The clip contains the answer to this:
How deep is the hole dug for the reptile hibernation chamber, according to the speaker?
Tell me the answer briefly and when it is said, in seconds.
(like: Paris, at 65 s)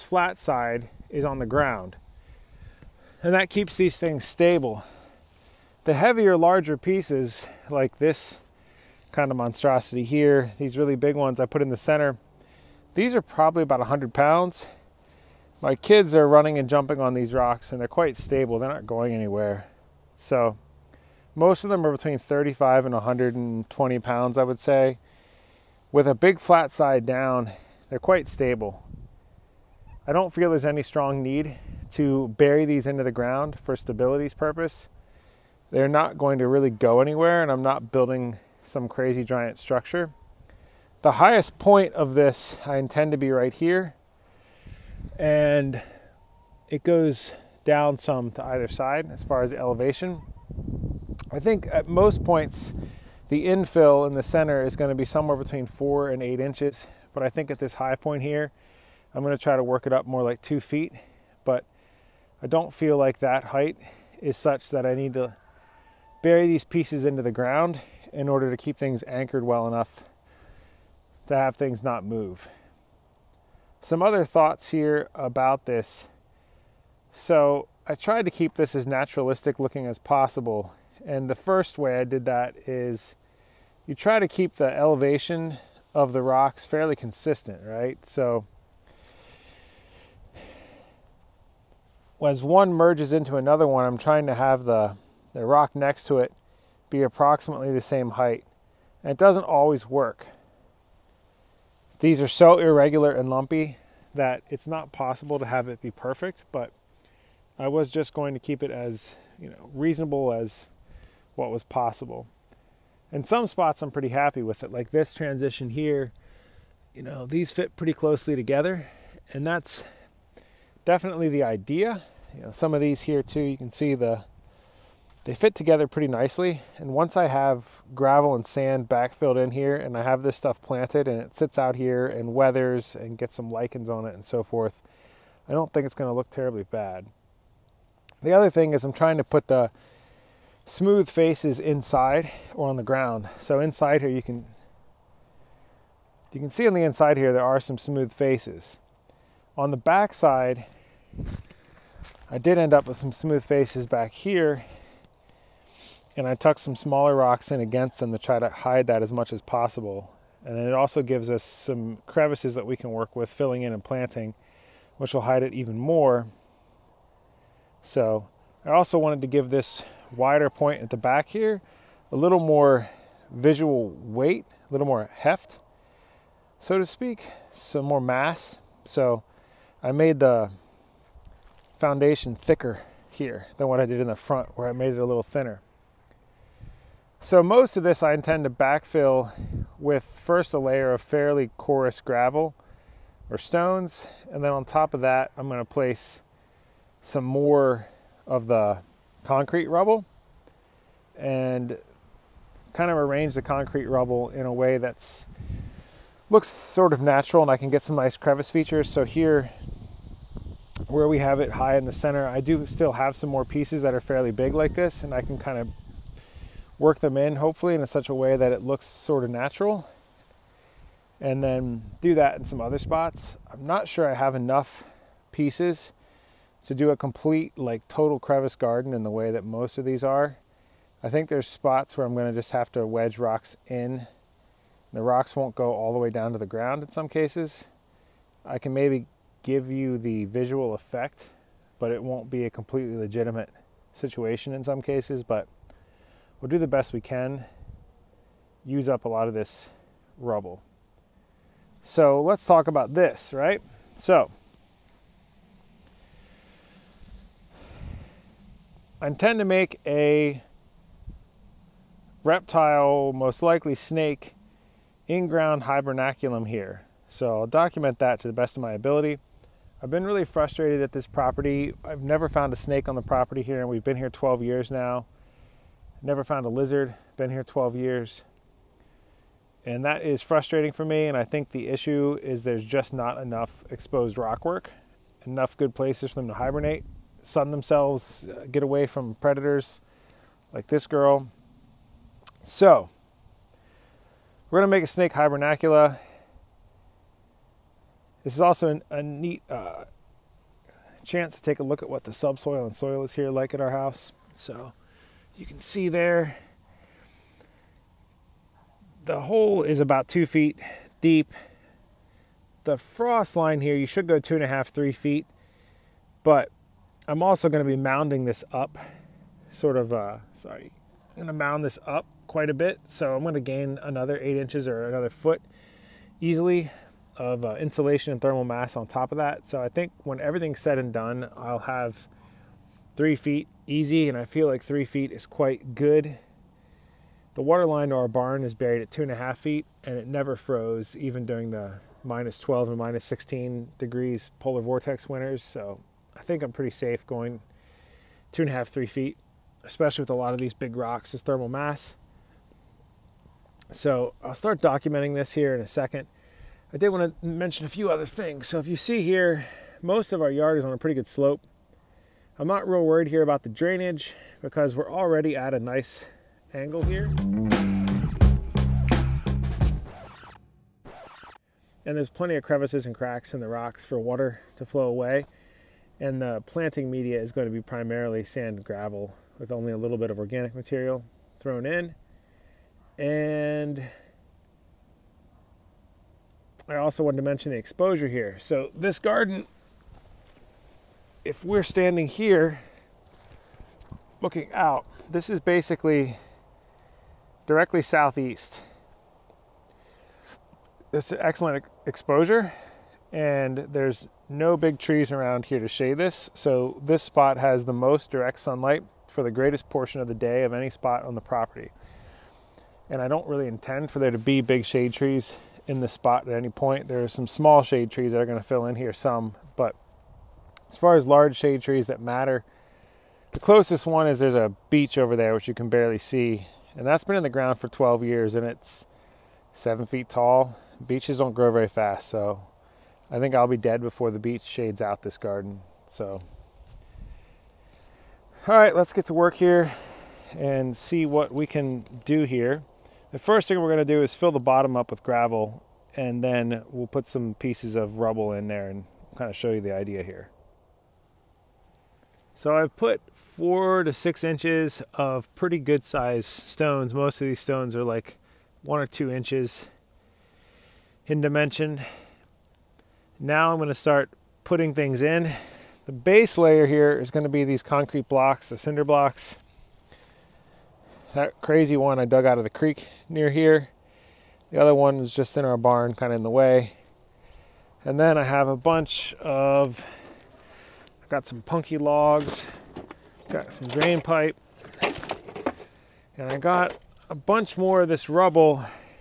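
2 feet, at 309 s.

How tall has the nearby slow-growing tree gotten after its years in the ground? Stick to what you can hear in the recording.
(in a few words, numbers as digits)
7 feet.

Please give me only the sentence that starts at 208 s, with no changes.
So here where we have it high in the center.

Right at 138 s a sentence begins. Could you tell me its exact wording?
The other thing is I'm trying to put the smooth faces inside or on the ground.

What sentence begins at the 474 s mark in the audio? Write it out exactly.
The other one is just in our barn, kind of in the way.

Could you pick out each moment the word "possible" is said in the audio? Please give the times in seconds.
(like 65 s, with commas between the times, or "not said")
79 s, 104 s, 111 s, 159 s.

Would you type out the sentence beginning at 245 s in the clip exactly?
But we'll do the best we can, use up a lot of this rubble.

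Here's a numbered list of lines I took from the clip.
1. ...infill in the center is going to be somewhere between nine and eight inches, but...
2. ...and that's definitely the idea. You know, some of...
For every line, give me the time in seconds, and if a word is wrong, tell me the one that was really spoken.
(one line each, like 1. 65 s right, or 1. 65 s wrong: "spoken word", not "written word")
1. 53 s wrong: "four", not "nine"
2. 119 s right.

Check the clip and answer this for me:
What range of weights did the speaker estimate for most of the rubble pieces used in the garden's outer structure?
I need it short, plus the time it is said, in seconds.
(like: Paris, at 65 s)
35 to 120 pounds, at 21 s.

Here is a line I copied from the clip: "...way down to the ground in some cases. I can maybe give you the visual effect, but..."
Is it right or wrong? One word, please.
right.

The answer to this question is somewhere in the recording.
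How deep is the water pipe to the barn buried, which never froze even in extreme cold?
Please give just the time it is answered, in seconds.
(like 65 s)
338 s.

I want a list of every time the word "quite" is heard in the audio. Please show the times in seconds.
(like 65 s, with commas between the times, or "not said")
17 s, 27 s, 322 s, 335 s.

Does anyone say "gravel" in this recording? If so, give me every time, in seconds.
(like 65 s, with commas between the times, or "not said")
127 s, 191 s, 378 s, 445 s.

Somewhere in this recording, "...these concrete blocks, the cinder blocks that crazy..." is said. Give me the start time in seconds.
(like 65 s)
467 s.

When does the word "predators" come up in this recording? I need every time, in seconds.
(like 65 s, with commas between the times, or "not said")
289 s.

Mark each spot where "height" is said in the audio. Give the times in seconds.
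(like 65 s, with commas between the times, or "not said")
63 s, 98 s.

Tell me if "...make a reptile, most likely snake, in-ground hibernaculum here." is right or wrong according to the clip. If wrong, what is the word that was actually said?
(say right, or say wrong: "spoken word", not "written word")
right.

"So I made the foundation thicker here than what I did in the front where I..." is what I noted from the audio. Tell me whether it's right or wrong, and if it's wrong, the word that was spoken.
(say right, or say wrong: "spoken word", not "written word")
right.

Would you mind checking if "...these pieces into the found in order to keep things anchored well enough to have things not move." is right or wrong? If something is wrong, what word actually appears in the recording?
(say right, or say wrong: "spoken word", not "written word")
wrong: "ground", not "found".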